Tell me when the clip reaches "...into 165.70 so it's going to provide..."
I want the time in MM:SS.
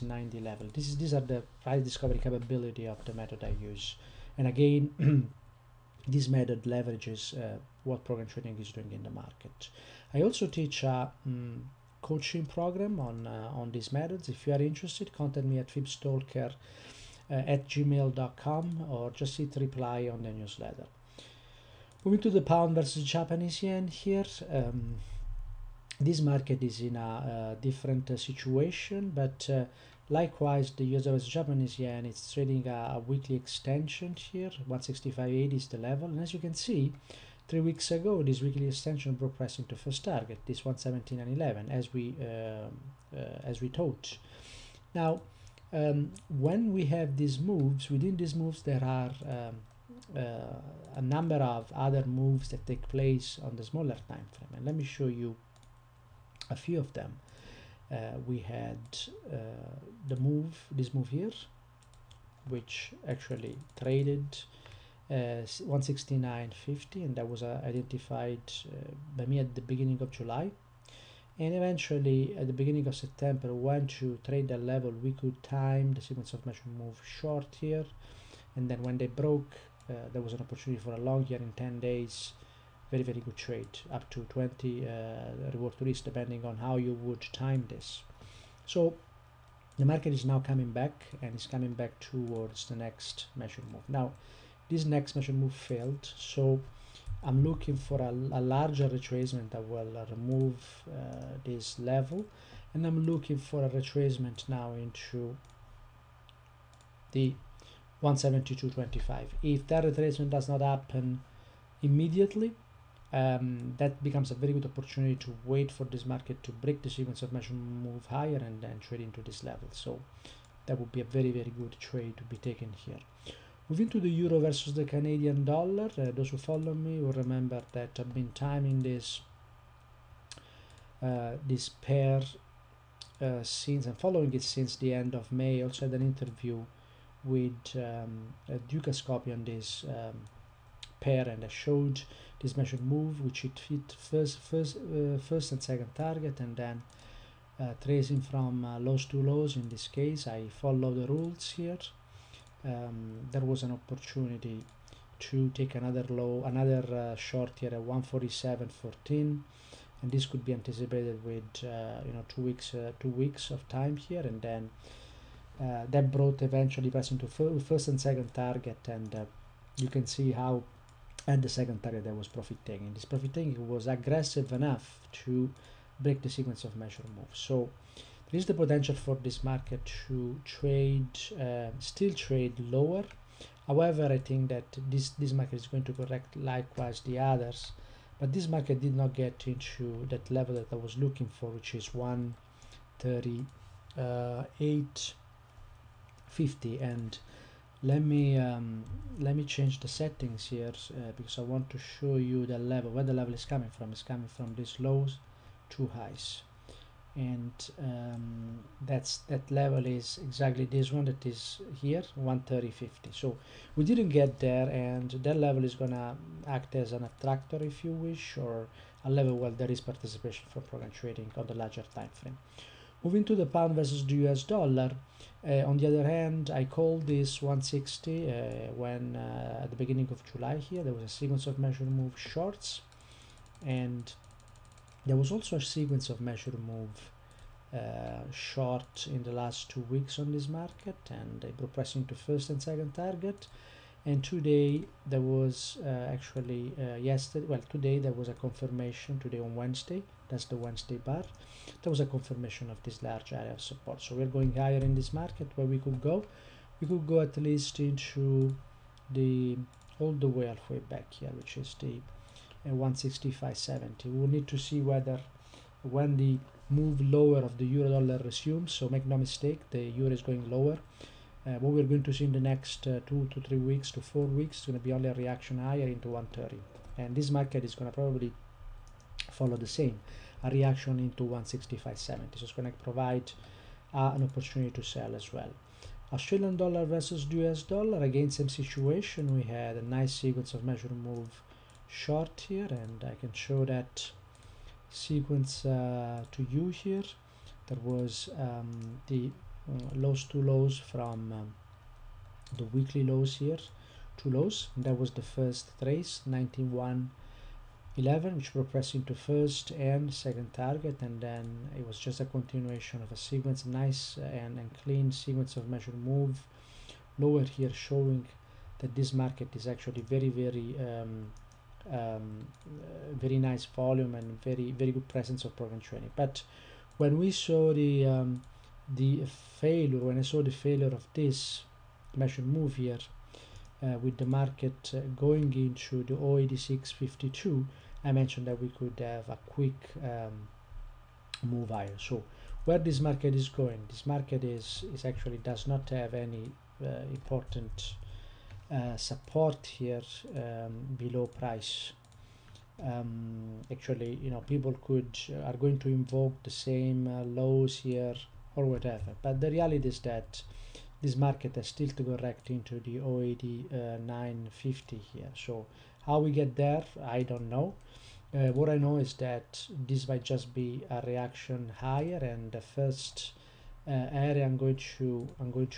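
04:40.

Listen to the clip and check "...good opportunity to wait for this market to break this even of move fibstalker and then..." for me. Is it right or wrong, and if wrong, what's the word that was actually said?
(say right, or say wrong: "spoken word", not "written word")
wrong: "higher", not "fibstalker".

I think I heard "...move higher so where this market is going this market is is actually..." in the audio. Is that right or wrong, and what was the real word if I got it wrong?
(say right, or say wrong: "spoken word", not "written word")
right.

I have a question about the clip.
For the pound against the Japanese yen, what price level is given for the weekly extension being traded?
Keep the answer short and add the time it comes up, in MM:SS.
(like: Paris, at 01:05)
165.80, at 00:34.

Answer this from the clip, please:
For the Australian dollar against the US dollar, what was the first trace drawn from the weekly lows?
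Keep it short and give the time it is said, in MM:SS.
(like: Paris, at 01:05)
91 11, at 05:06.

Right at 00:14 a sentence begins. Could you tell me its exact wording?
If you are interested, contact me at fibstalker uh, at gmail.com or just hit reply on the newsletter.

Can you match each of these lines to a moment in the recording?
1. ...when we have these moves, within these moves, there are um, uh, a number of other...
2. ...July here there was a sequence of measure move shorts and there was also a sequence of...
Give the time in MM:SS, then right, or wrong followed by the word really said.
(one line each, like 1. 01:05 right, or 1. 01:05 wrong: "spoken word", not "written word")
1. 00:46 right
2. 03:50 right.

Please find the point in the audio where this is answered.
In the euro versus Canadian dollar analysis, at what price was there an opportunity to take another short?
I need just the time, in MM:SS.
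02:37.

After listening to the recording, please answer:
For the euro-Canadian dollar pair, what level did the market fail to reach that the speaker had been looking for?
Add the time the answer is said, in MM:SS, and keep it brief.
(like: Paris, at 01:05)
138.50, at 03:11.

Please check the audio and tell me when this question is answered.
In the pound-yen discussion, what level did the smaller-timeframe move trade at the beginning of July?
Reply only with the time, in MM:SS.
01:06.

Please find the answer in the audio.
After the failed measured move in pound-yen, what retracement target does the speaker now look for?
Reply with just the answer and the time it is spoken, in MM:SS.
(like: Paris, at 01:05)
172.25, at 01:48.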